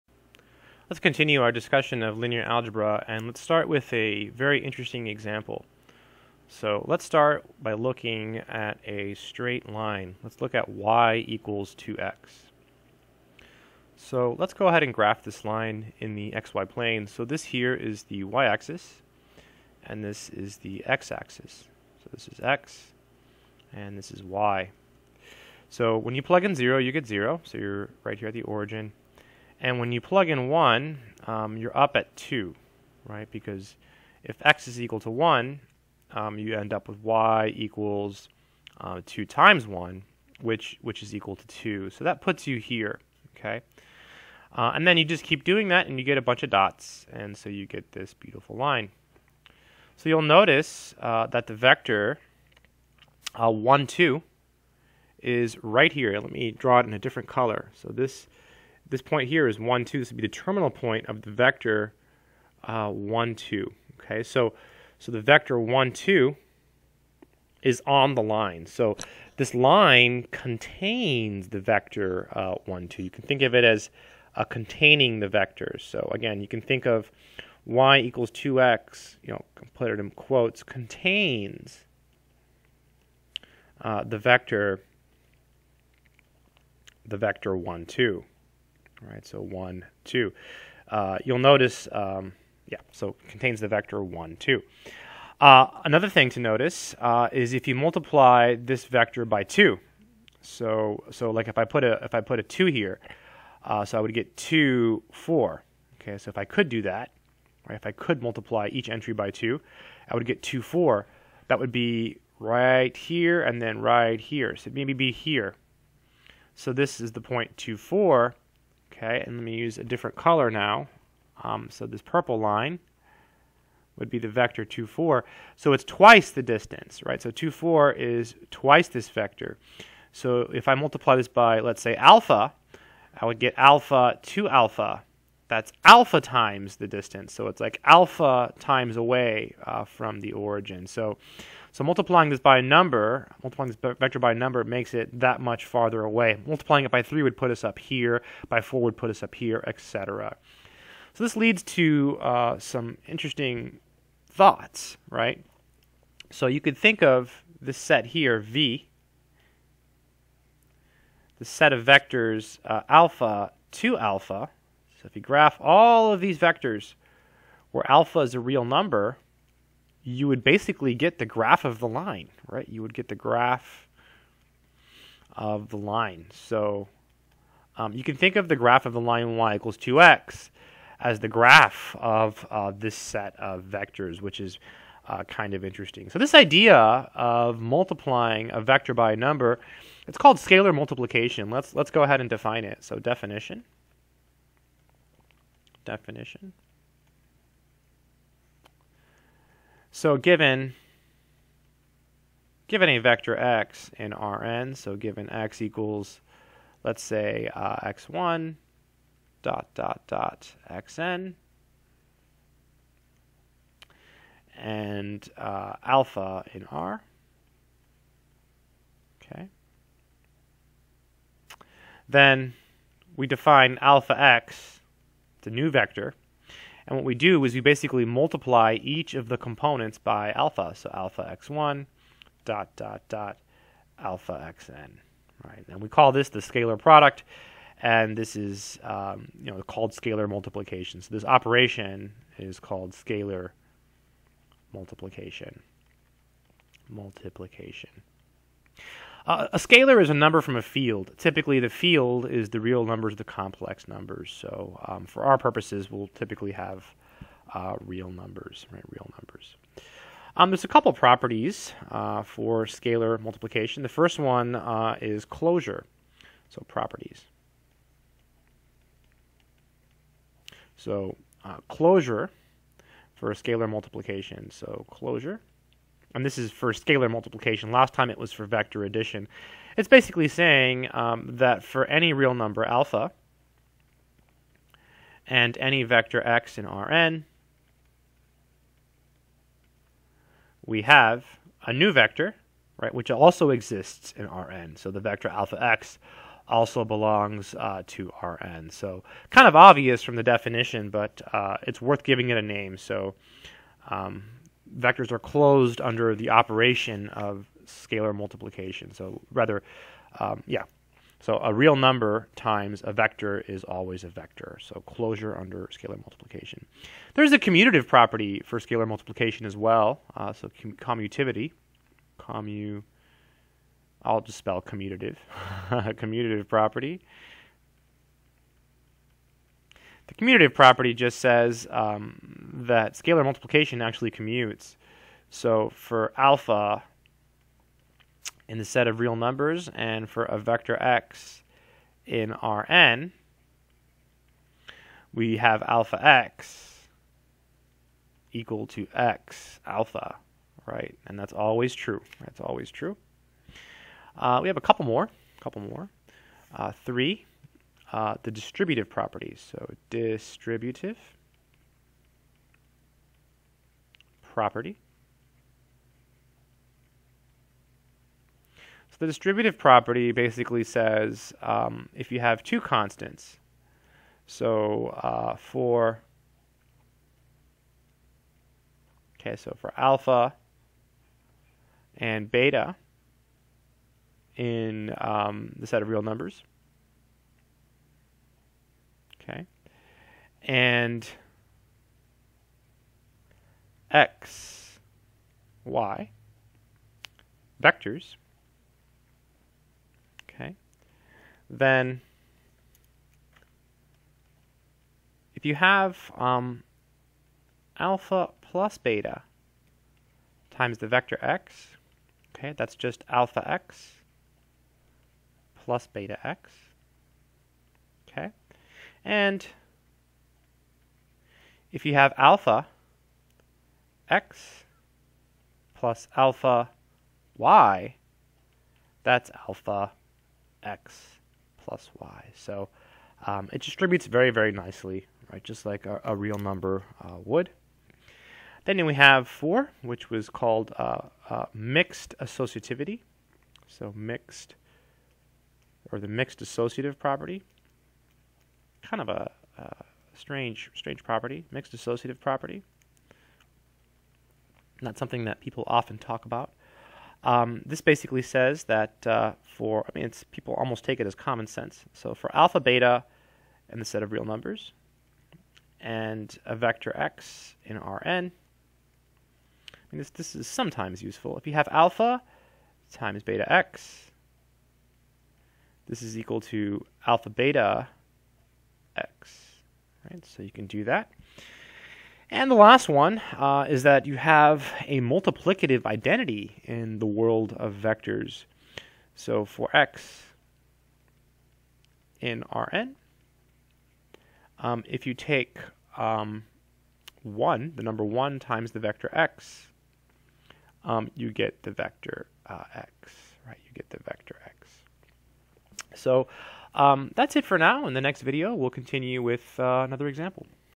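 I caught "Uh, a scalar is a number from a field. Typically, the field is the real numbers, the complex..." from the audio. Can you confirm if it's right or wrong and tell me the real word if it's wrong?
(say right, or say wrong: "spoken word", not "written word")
right.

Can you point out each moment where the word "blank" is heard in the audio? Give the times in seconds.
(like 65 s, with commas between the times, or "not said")
not said.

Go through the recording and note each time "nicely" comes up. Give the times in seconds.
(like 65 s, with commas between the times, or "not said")
434 s.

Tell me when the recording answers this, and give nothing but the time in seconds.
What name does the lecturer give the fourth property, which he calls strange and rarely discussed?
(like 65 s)
441 s.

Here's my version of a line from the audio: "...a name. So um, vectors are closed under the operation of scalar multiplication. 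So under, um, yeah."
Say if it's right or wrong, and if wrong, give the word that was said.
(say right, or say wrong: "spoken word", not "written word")
wrong: "rather", not "under".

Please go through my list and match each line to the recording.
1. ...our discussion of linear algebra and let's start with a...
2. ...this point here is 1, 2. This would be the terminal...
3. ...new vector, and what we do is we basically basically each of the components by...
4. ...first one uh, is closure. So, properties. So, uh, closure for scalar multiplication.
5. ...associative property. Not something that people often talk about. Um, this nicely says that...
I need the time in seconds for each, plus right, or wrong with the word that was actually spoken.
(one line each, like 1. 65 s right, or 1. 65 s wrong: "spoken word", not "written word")
1. 1 s right
2. 58 s right
3. 225 s wrong: "multiply", not "basically"
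4. 263 s right
5. 451 s wrong: "basically", not "nicely".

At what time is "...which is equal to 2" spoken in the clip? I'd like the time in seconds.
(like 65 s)
40 s.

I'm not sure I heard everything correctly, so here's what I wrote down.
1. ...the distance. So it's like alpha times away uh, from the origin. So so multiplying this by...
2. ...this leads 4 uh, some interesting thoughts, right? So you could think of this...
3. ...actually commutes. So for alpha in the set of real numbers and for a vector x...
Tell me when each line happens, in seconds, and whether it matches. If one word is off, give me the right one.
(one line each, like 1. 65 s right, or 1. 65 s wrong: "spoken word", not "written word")
1. 136 s right
2. 151 s wrong: "2", not "4"
3. 333 s right.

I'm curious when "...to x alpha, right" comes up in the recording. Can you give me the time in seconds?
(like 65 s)
348 s.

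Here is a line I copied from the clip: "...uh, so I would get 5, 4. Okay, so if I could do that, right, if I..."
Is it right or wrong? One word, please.
wrong.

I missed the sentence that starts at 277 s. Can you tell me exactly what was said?
Last time it was for vector addition.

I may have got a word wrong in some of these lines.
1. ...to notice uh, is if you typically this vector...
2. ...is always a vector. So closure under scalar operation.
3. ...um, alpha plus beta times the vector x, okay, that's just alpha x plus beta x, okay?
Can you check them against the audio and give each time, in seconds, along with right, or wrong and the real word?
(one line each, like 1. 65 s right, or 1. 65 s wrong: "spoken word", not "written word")
1. 96 s wrong: "multiply", not "typically"
2. 313 s wrong: "multiplication", not "operation"
3. 406 s right.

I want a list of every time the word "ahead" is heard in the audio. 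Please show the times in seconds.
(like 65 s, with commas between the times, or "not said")
14 s, 192 s.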